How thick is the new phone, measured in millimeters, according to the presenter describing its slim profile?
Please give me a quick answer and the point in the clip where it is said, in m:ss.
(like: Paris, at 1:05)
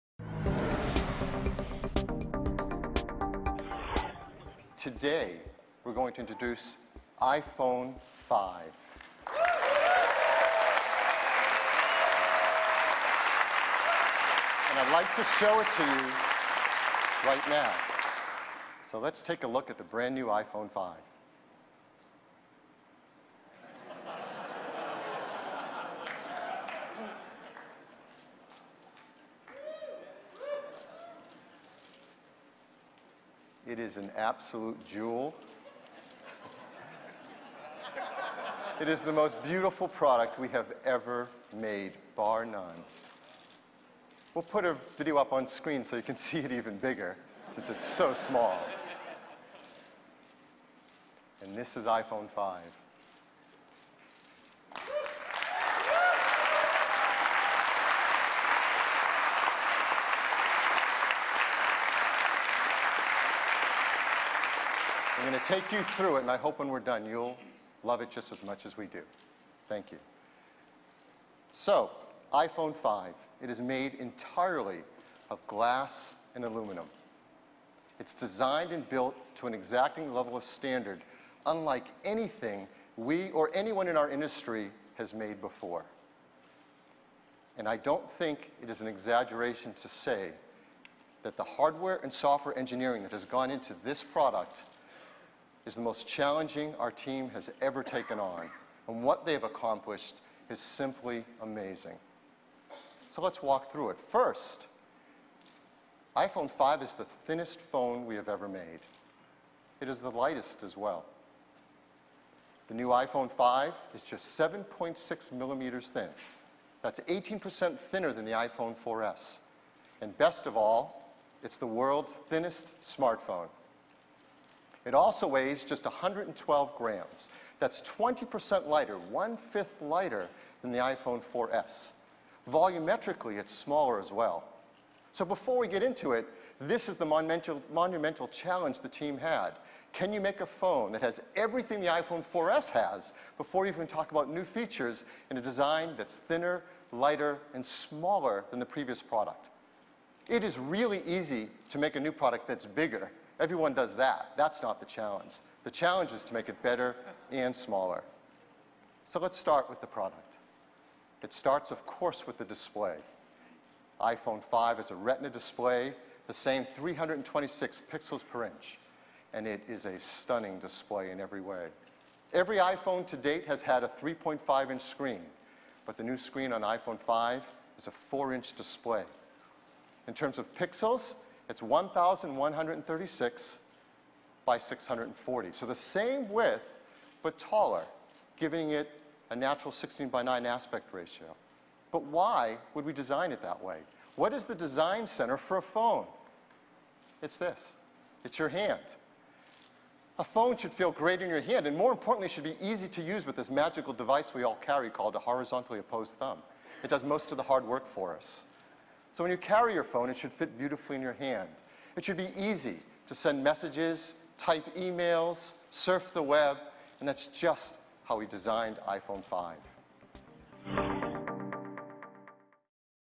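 7.6 millimeters, at 1:54.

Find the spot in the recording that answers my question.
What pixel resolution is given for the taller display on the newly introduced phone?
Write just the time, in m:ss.
3:01.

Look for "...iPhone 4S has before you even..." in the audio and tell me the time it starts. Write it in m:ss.
2:21.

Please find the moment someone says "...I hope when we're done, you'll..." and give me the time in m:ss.
1:06.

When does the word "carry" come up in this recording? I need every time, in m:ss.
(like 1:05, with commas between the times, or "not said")
3:24, 3:29.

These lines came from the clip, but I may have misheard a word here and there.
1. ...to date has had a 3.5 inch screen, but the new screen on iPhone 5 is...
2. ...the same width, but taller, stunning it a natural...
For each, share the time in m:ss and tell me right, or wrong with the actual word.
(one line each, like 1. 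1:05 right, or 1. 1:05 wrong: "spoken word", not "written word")
1. 2:53 right
2. 3:05 wrong: "giving", not "stunning".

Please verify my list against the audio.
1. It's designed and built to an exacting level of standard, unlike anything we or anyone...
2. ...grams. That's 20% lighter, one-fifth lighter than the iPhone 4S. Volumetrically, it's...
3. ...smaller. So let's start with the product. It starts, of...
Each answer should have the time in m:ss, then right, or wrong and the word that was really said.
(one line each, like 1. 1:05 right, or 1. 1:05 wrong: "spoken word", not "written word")
1. 1:17 right
2. 2:06 right
3. 2:37 right.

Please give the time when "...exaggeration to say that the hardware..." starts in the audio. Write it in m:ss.
1:28.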